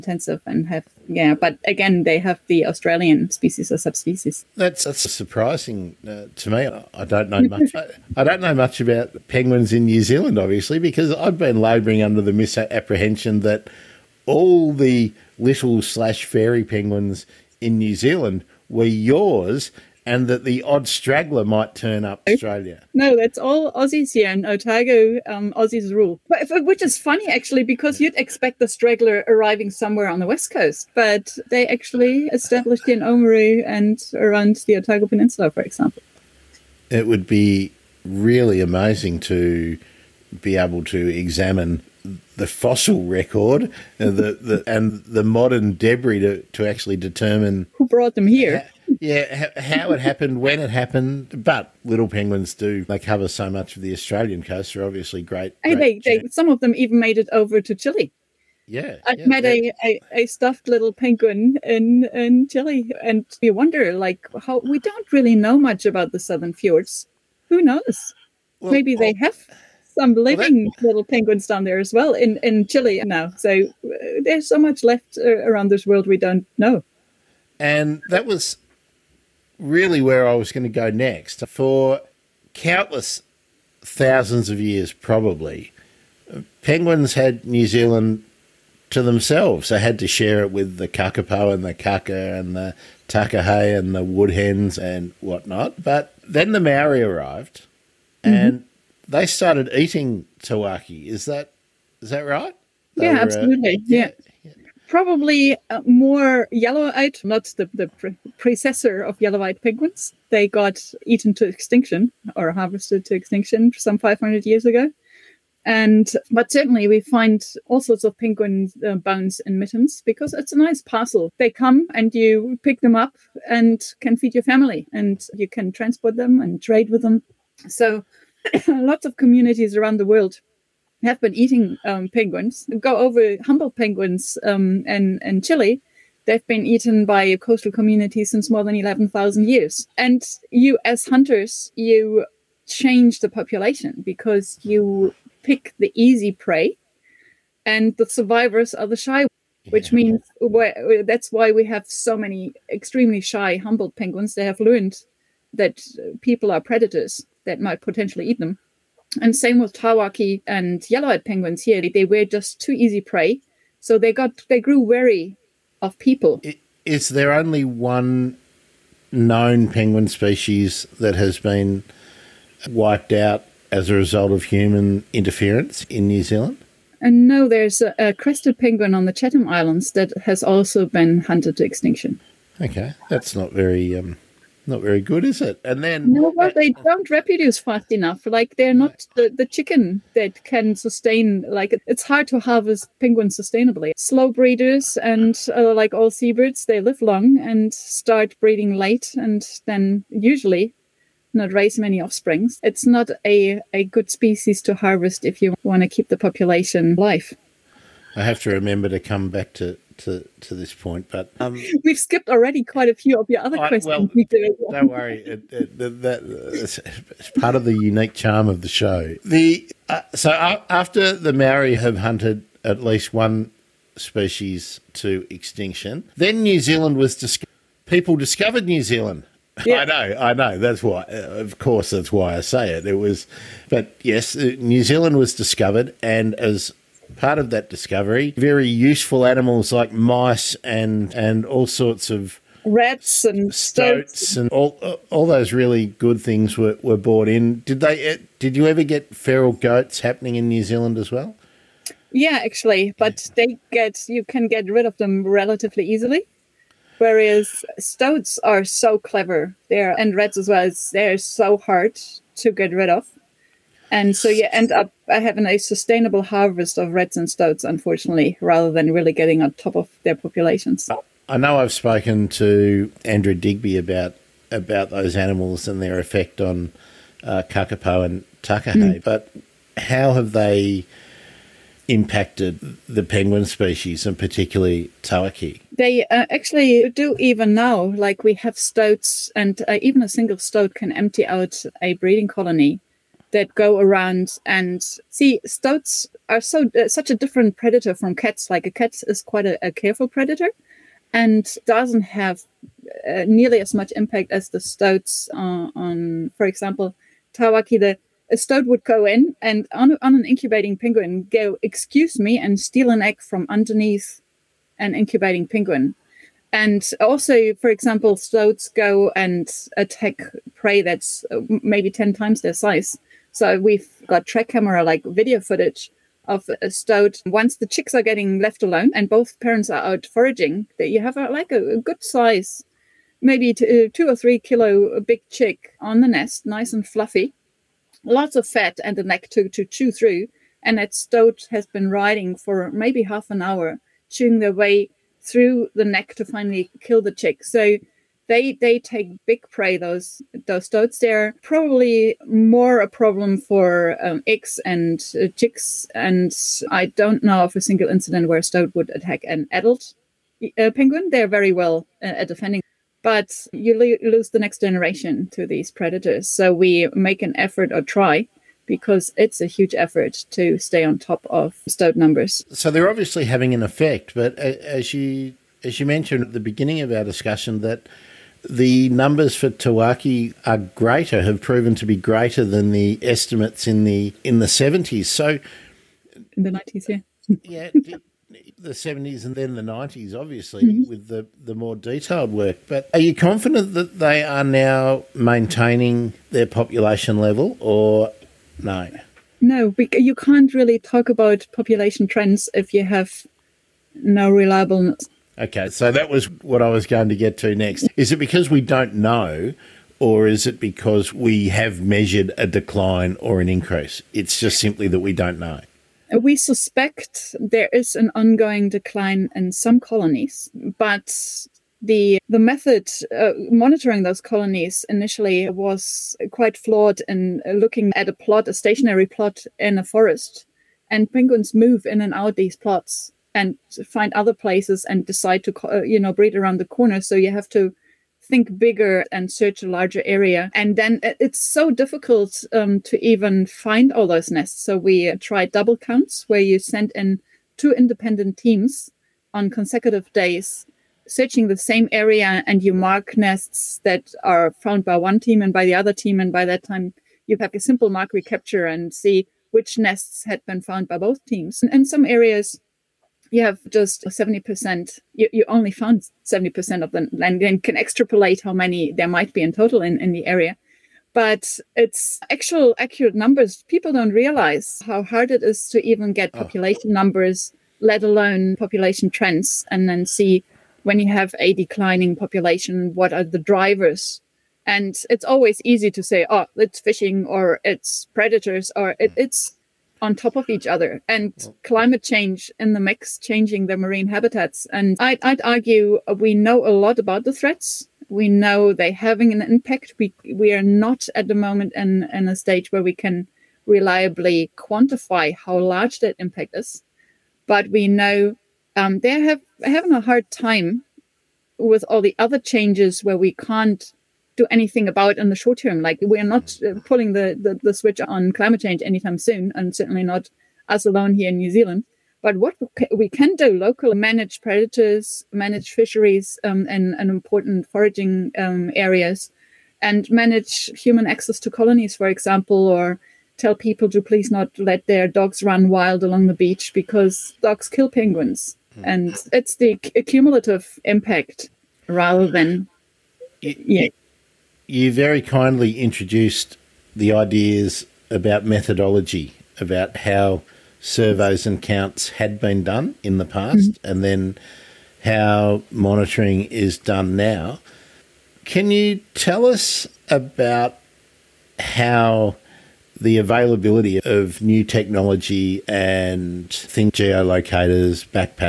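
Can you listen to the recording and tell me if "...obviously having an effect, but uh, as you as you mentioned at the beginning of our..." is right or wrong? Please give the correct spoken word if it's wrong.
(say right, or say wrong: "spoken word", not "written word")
right.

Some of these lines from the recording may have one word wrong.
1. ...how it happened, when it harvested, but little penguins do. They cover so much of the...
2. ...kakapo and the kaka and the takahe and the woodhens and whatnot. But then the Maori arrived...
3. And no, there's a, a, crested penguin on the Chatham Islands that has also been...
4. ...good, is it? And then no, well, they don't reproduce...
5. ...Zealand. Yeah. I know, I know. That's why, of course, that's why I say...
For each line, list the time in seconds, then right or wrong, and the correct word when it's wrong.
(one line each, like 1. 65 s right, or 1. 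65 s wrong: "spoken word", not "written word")
1. 49 s wrong: "happened", not "harvested"
2. 90 s right
3. 176 s right
4. 184 s right
5. 228 s right.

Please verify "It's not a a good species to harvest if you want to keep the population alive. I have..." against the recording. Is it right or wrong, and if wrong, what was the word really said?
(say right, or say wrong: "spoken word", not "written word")
right.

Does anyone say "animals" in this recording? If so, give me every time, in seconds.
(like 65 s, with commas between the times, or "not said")
239 s, 275 s.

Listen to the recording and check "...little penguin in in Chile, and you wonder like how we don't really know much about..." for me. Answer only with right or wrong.
right.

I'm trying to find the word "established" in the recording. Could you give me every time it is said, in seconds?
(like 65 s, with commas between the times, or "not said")
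32 s.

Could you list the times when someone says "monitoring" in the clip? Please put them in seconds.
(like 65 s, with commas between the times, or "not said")
423 s, 555 s.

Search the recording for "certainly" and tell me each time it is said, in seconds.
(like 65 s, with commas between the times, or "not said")
116 s, 519 s.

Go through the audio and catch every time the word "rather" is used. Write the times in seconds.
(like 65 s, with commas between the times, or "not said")
268 s, 541 s.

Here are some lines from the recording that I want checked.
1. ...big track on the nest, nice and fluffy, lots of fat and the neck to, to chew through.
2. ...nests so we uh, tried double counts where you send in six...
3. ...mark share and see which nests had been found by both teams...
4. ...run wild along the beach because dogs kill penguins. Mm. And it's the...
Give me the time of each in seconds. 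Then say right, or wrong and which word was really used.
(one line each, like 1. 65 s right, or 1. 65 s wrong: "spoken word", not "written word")
1. 334 s wrong: "chick", not "track"
2. 444 s wrong: "two", not "six"
3. 457 s wrong: "recapture", not "share"
4. 535 s right.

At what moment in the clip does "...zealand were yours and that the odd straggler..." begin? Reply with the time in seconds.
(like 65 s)
17 s.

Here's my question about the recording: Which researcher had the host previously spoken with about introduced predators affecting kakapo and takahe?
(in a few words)
Andrew Digby.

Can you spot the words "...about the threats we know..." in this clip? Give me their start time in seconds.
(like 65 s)
496 s.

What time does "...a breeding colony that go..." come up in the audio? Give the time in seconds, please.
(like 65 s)
291 s.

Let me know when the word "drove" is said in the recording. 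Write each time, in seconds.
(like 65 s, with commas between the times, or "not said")
not said.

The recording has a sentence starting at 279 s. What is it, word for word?
but how have they impacted the penguin species and particularly tawaki?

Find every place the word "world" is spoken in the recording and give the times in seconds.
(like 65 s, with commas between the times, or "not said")
75 s, 130 s.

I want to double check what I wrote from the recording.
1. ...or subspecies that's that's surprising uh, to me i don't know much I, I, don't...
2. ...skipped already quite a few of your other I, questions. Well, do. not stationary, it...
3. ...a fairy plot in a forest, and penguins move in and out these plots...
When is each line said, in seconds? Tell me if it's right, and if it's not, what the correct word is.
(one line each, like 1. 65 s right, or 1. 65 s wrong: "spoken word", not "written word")
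1. 3 s right
2. 211 s wrong: "worry", not "stationary"
3. 428 s wrong: "stationary", not "fairy".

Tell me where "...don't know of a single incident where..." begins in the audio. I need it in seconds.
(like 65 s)
356 s.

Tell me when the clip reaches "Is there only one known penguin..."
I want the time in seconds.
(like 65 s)
166 s.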